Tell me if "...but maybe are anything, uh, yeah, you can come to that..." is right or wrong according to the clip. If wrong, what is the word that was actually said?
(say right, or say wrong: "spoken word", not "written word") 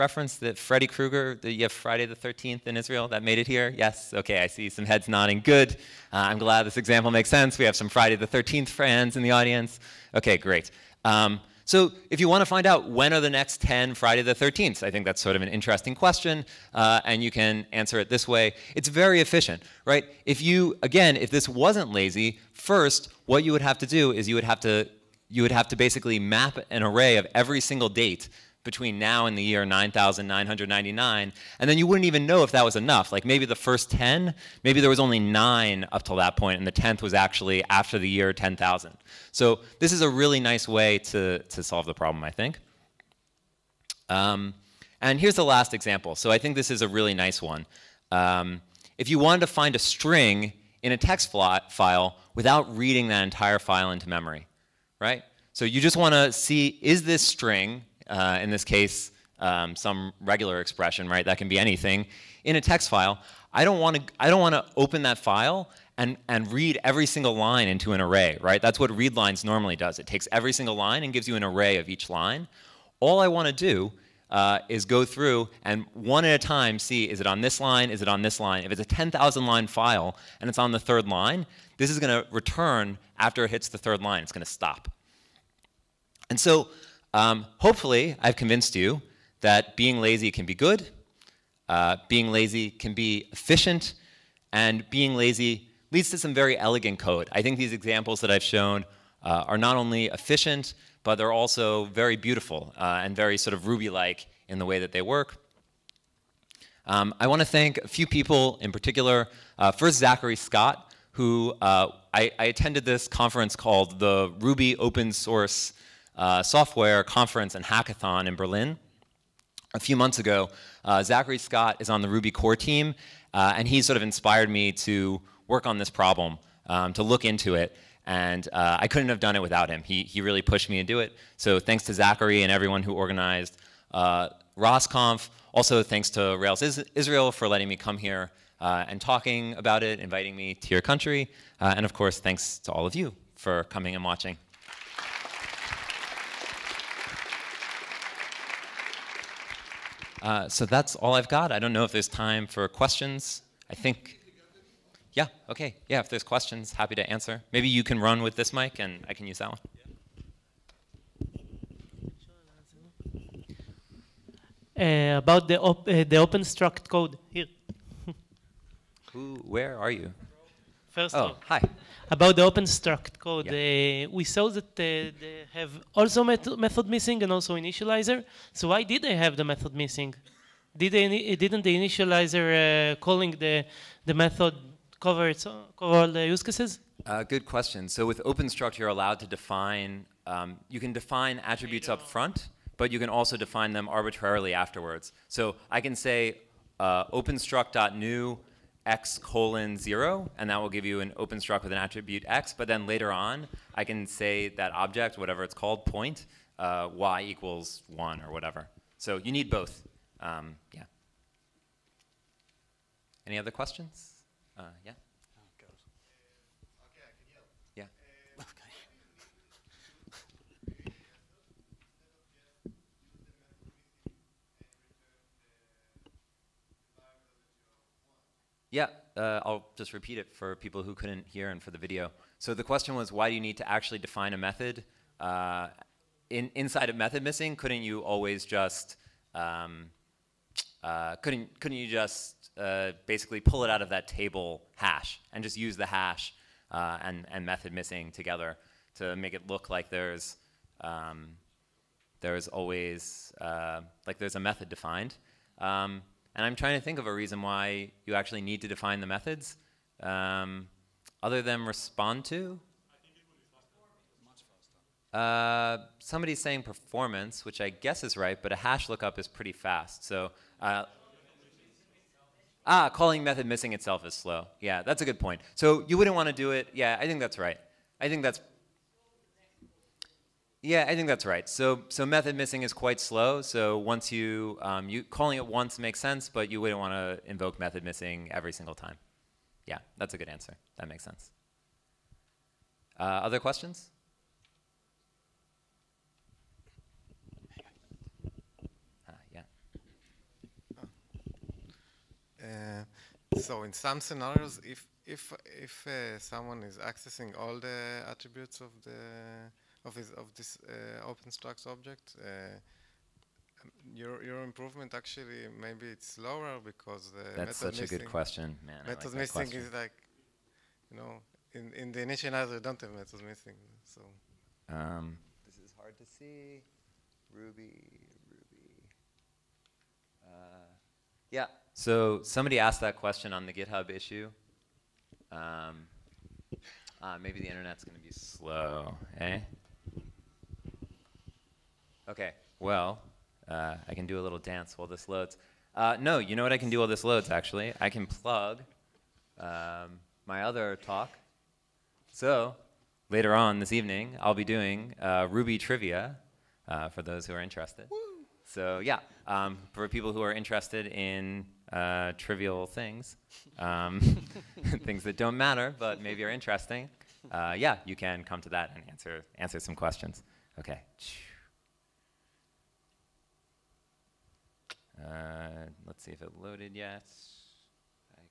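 wrong: "interesting", not "anything".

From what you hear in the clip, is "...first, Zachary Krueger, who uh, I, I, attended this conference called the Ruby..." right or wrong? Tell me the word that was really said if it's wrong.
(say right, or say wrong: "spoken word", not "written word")
wrong: "Scott", not "Krueger".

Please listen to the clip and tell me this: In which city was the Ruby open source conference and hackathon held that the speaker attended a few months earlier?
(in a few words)
Berlin.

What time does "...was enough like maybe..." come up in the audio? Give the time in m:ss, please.
0:32.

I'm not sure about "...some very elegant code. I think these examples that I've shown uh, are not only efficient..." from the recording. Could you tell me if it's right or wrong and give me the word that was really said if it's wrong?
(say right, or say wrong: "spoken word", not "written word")
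right.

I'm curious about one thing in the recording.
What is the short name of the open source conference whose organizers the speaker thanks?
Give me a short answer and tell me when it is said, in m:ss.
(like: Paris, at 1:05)
ROSSConf, at 2:14.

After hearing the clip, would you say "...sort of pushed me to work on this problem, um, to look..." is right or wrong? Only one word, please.
wrong.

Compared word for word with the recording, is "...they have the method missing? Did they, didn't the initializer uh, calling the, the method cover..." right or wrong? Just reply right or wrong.
right.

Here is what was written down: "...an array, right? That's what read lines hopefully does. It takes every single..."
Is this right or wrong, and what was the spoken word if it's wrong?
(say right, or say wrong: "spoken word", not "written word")
wrong: "normally", not "hopefully".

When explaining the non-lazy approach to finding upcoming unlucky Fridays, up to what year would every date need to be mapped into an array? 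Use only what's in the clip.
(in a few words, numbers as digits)
9999.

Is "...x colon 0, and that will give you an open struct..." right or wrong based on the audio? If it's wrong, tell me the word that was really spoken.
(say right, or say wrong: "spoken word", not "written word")
right.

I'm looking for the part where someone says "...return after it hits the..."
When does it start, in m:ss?
1:22.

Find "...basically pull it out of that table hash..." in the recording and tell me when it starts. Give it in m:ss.
4:03.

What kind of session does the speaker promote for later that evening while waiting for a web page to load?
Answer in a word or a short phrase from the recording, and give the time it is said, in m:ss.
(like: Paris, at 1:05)
Ruby trivia, at 5:55.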